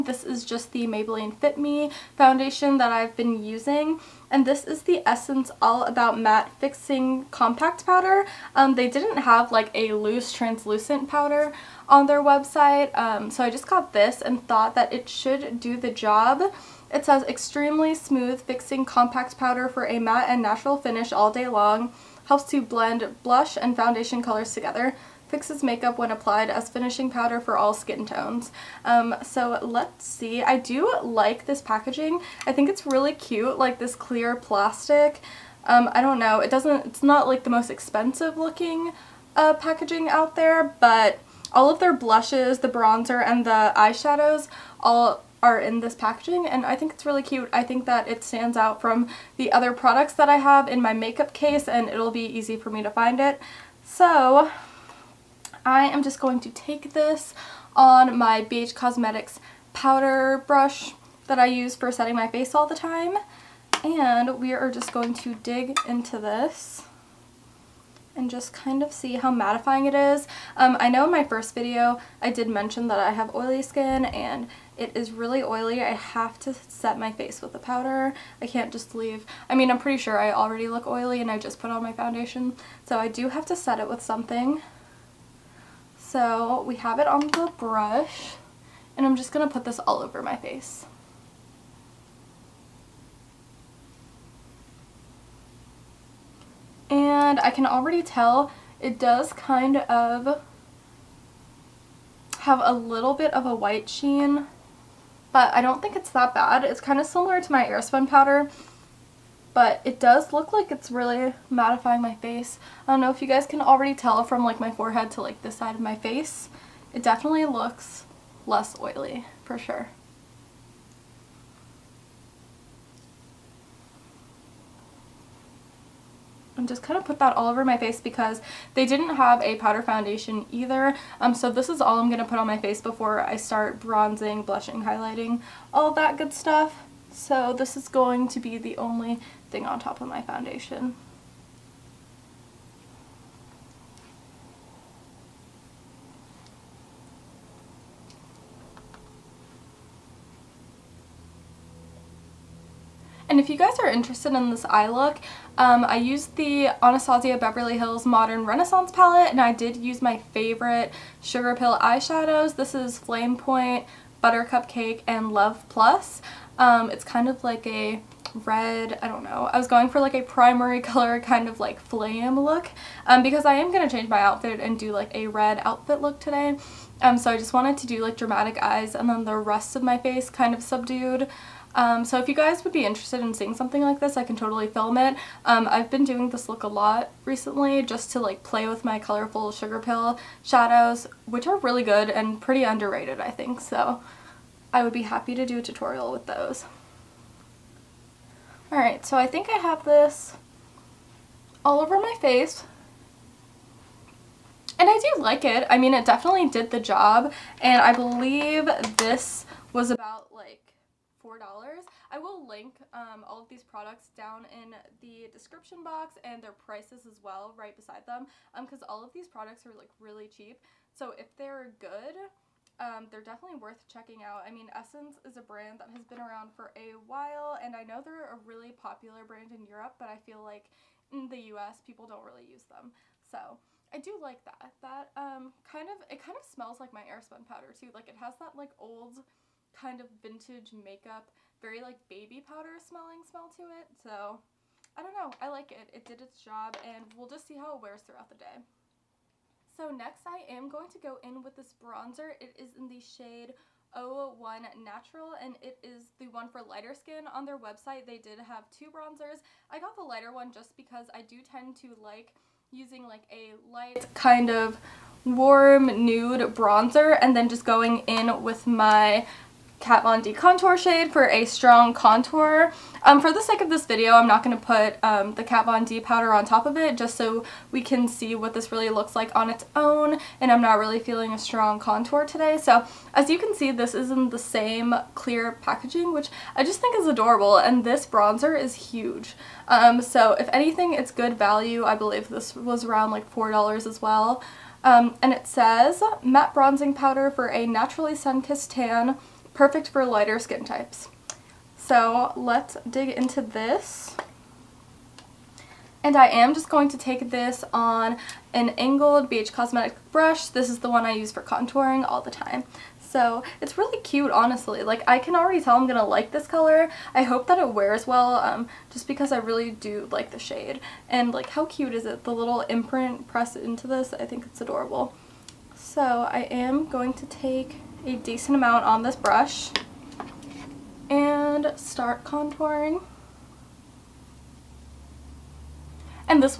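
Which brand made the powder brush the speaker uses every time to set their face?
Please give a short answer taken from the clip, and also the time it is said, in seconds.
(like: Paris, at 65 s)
BH Cosmetics, at 58 s.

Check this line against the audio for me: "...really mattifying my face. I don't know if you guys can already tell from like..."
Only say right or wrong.
right.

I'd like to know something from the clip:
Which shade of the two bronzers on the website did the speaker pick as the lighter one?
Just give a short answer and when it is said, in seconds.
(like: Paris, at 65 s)
01 Natural, at 253 s.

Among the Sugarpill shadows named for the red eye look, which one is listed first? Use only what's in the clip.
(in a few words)
Flamepoint.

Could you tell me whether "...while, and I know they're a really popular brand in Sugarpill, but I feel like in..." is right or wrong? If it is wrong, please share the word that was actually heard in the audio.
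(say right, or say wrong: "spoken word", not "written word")
wrong: "Europe", not "Sugarpill".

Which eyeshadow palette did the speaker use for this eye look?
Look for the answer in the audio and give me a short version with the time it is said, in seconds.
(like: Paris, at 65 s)
Modern Renaissance, at 158 s.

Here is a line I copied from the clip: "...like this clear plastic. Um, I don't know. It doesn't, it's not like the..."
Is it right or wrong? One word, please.
right.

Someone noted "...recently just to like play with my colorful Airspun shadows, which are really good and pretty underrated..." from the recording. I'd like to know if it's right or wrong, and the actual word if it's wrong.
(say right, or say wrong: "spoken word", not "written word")
wrong: "Sugarpill", not "Airspun".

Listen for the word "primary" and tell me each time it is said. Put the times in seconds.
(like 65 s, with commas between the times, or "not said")
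170 s.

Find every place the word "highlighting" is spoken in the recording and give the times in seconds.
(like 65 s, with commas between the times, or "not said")
134 s.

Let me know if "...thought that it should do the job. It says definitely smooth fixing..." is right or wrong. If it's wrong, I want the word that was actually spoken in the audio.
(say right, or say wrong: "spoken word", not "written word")
wrong: "extremely", not "definitely".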